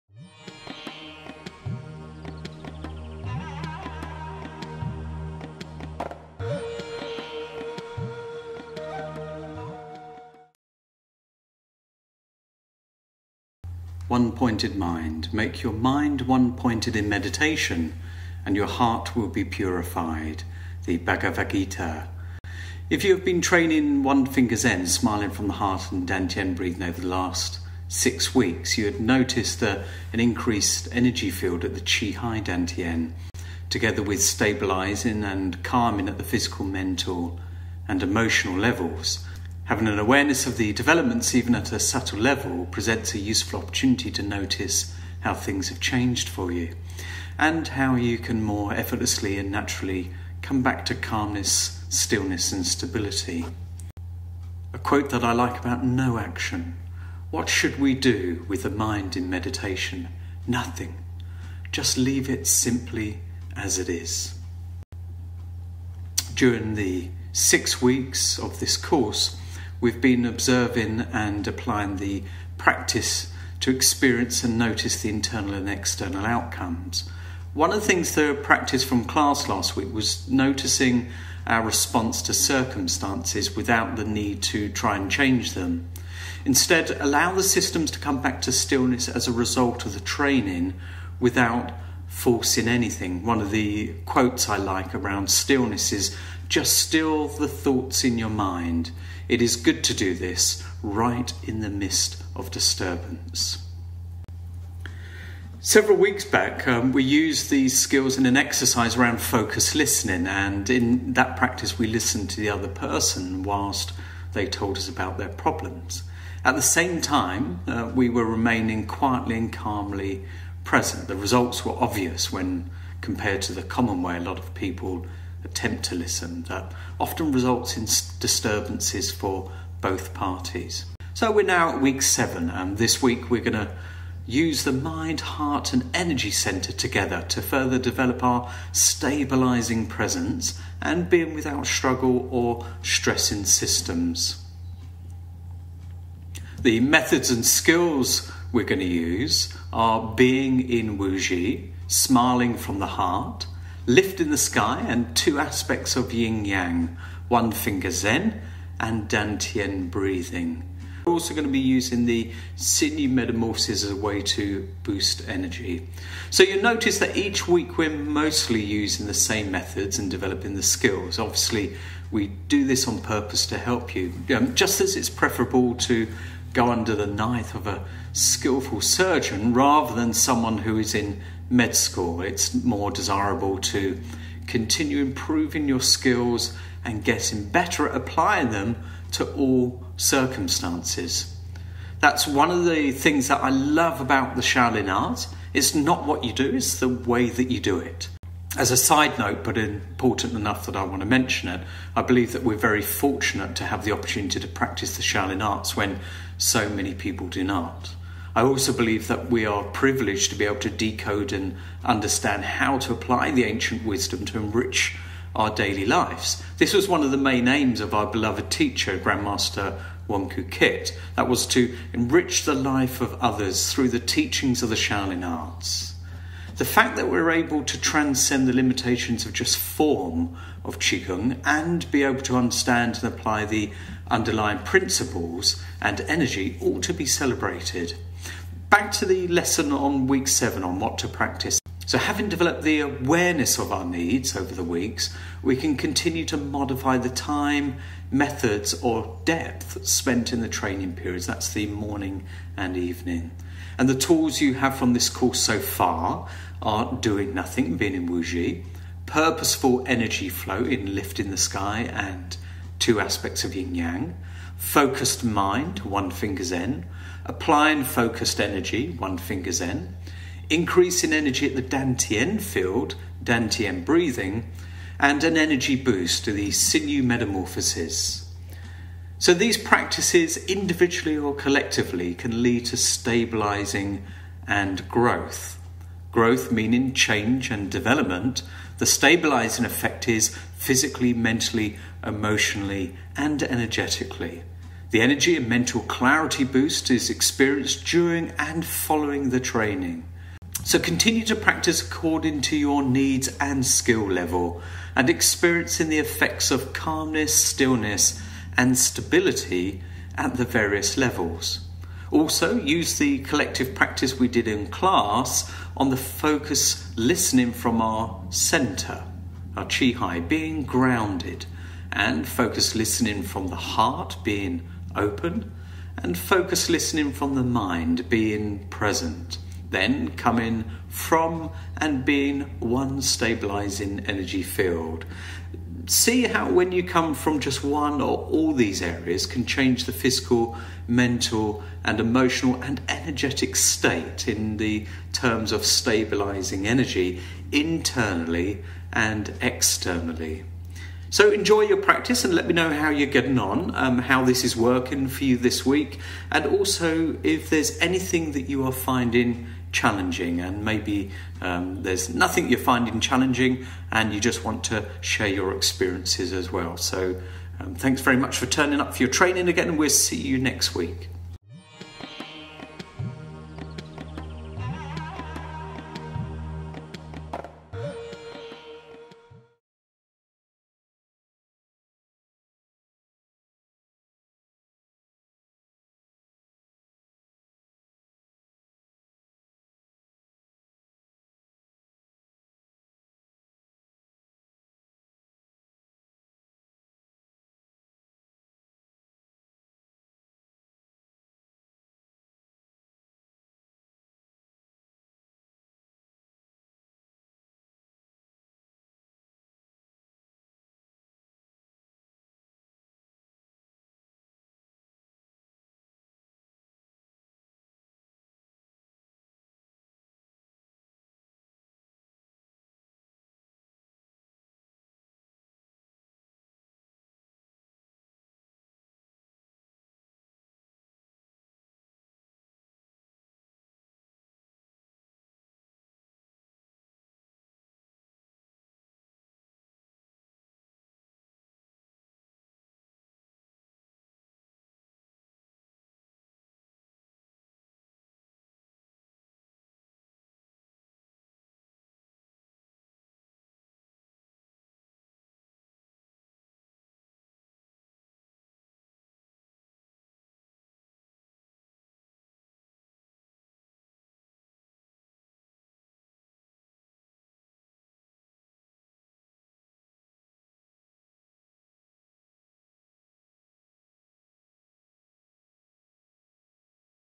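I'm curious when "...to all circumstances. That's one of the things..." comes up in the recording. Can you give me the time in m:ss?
3:09.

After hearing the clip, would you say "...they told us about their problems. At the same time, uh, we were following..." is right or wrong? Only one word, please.
wrong.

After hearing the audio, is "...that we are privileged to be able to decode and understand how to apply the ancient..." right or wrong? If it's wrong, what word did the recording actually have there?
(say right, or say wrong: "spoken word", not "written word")
right.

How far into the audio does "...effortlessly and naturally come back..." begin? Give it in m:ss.
0:48.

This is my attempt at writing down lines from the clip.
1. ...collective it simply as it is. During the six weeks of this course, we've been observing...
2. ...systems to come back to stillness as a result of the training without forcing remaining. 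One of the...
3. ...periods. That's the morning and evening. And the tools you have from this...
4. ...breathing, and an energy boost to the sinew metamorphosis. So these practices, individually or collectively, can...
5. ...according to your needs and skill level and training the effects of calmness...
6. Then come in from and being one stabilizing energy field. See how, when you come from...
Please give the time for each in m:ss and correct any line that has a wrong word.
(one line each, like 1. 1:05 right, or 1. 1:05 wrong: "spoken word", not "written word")
1. 1:01 wrong: "leave", not "collective"
2. 1:27 wrong: "anything", not "remaining"
3. 4:10 right
4. 4:33 right
5. 5:01 wrong: "experiencing", not "training"
6. 5:29 right.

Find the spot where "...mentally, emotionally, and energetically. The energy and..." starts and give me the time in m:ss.
4:51.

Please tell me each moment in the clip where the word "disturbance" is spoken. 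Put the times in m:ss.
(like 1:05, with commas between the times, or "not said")
1:42, 2:08.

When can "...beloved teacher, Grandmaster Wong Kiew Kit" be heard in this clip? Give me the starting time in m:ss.
3:38.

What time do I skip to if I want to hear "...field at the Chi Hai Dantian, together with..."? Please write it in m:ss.
0:31.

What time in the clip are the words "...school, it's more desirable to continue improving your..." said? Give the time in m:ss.
3:01.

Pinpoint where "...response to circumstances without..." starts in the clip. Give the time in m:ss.
1:21.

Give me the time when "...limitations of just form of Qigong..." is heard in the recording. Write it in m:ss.
3:48.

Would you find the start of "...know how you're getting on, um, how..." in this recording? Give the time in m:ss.
5:52.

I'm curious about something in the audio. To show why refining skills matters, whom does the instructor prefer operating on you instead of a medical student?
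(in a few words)
A skillful surgeon.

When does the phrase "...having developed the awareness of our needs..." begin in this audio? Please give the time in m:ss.
4:01.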